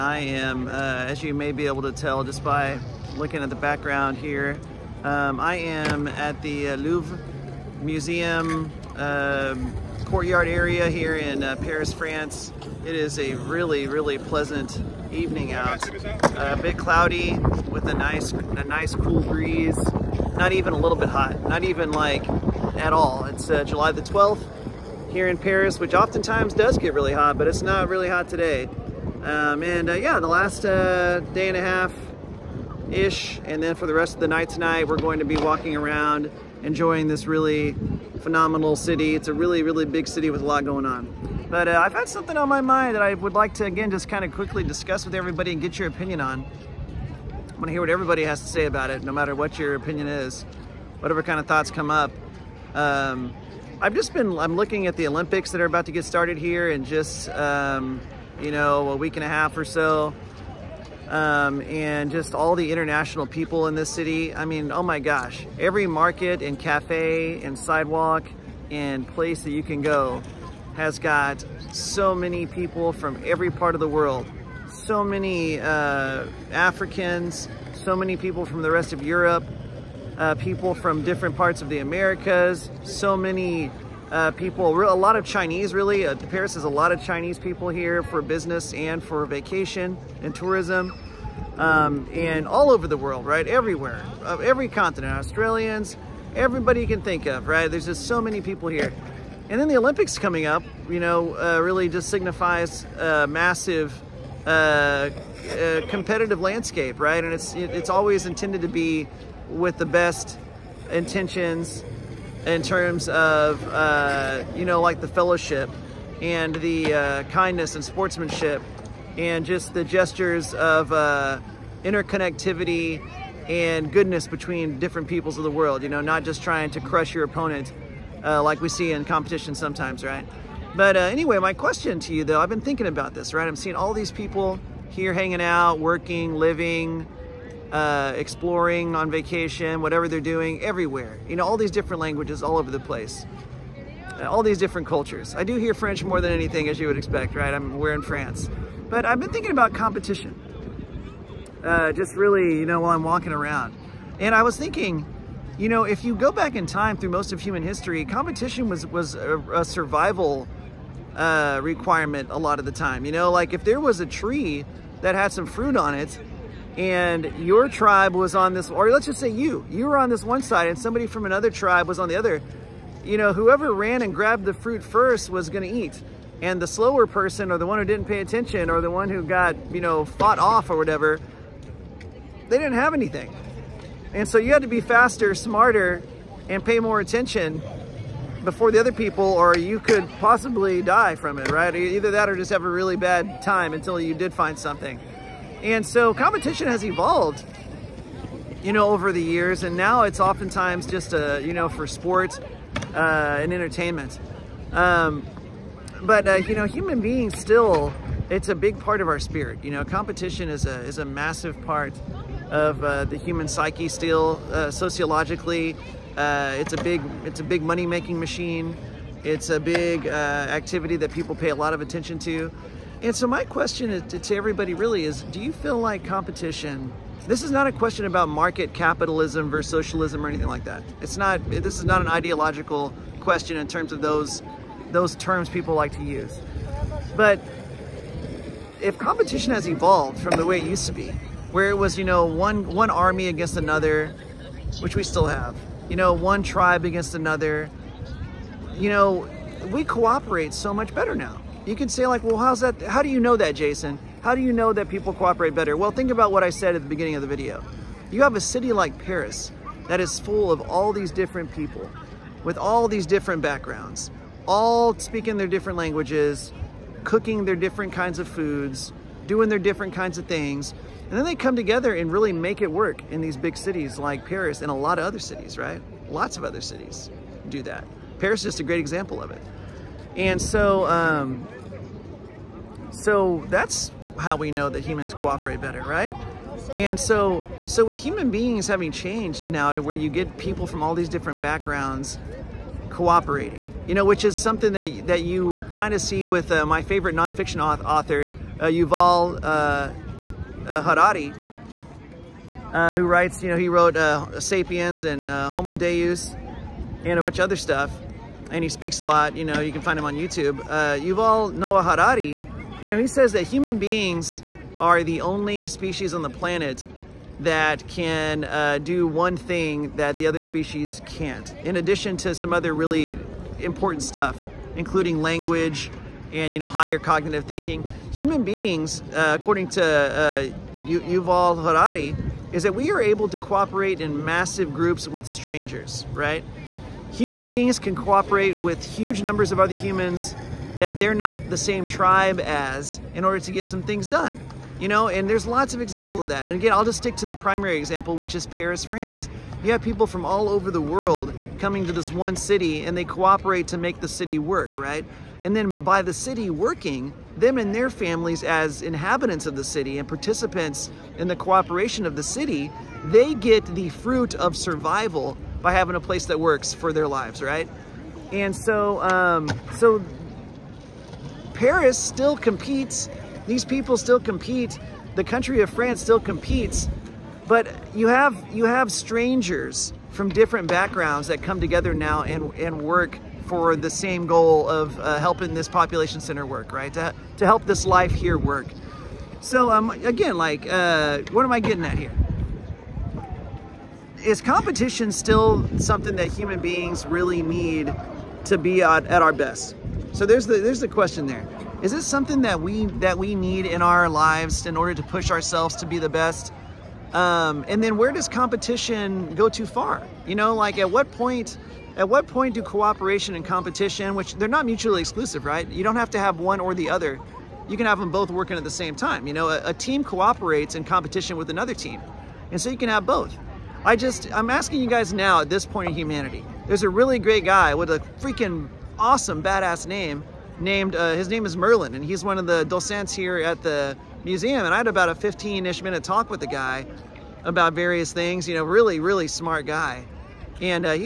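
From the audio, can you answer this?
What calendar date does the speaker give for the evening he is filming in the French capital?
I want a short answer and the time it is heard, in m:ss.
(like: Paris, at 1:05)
July 12, at 0:23.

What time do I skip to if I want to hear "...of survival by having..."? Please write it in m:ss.
6:04.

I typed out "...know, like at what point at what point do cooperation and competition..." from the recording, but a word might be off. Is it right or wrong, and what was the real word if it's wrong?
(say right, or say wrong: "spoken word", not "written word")
right.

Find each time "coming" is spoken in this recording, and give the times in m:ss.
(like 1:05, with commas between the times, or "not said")
1:40, 5:51.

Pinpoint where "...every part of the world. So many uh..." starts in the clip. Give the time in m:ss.
1:13.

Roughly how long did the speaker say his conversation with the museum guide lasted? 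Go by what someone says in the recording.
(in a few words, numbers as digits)
15 minutes.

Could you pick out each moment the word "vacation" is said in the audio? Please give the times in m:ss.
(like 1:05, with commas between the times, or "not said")
1:29, 2:19.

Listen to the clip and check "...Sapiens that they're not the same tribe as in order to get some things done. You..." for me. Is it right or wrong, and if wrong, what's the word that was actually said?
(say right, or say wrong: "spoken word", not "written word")
wrong: "humans", not "Sapiens".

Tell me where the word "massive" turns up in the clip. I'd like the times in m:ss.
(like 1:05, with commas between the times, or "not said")
1:43, 3:31, 5:34.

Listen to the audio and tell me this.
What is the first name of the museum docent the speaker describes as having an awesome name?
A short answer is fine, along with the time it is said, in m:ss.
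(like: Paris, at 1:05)
Merlin, at 7:11.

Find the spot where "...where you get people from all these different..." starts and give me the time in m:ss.
4:49.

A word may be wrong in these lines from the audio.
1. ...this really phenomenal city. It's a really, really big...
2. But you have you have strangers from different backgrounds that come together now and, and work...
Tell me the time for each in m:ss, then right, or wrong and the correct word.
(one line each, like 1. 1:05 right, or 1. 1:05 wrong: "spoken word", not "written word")
1. 0:37 right
2. 6:17 right.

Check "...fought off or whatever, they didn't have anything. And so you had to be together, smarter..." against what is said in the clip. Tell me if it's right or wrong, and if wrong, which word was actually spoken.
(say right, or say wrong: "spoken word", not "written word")
wrong: "faster", not "together".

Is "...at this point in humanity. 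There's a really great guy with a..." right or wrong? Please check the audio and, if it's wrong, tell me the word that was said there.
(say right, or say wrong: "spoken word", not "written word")
right.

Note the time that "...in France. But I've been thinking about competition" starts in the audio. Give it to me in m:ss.
2:27.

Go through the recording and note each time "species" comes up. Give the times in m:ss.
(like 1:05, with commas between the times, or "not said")
5:15, 5:20.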